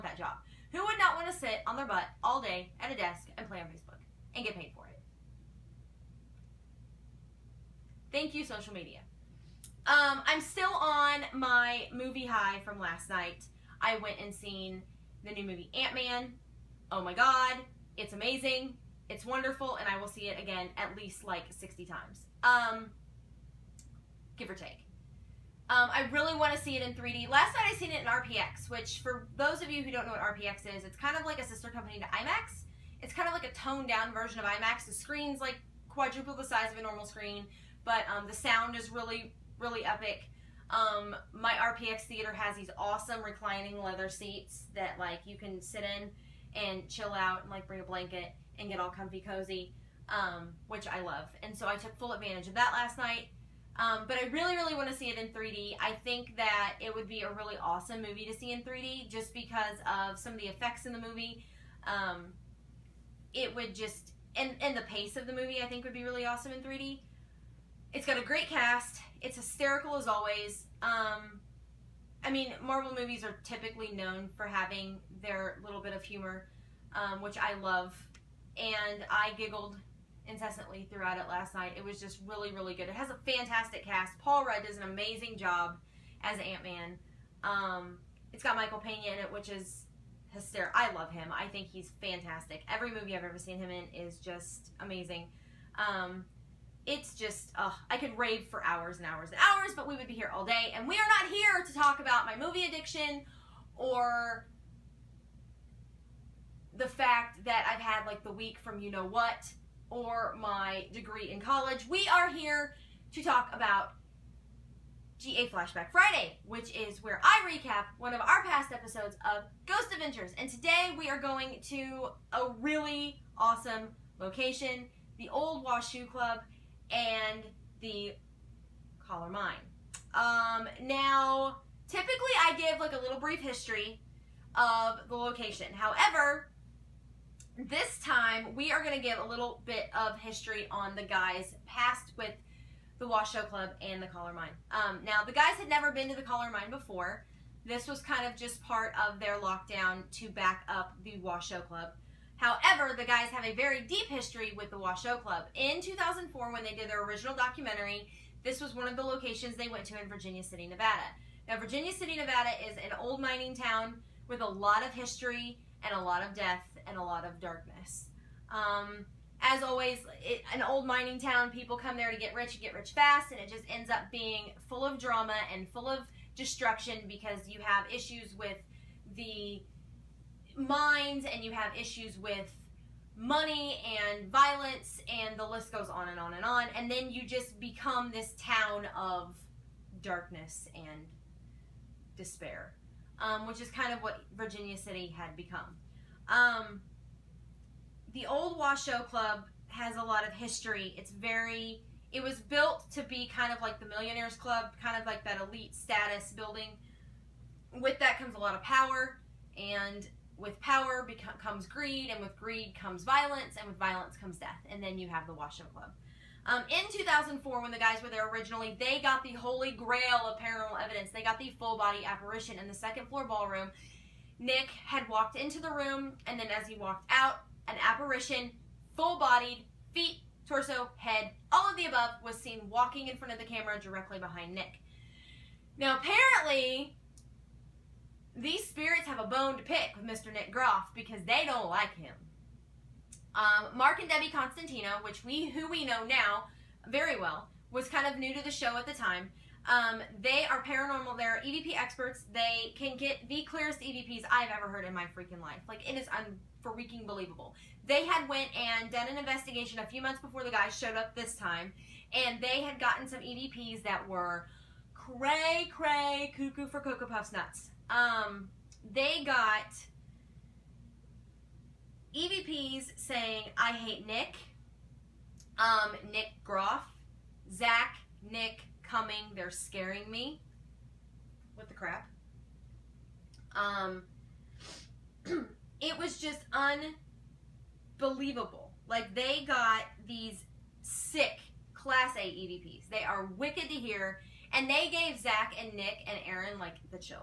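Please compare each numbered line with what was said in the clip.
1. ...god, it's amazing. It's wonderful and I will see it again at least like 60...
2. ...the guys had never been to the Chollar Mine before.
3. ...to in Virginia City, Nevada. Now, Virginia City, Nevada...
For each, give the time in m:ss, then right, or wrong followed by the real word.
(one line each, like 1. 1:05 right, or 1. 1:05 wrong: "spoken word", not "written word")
1. 0:17 right
2. 2:25 right
3. 2:39 right.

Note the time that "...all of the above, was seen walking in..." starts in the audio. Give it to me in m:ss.
3:51.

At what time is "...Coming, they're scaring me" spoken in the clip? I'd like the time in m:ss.
4:38.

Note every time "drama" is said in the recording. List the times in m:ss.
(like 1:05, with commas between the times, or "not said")
2:54.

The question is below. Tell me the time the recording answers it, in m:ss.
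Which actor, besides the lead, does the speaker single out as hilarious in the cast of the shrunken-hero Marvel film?
1:28.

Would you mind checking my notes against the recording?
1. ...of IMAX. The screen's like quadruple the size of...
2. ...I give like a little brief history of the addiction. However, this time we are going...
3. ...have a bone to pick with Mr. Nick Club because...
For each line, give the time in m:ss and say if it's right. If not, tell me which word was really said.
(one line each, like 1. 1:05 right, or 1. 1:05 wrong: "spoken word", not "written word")
1. 0:34 right
2. 2:12 wrong: "location", not "addiction"
3. 3:59 wrong: "Groff", not "Club".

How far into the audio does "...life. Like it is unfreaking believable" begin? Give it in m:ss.
4:15.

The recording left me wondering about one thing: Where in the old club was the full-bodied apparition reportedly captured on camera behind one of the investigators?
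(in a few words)
second floor ballroom.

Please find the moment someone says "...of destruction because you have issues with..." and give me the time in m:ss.
2:55.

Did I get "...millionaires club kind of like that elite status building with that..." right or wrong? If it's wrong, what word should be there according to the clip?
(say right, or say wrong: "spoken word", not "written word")
right.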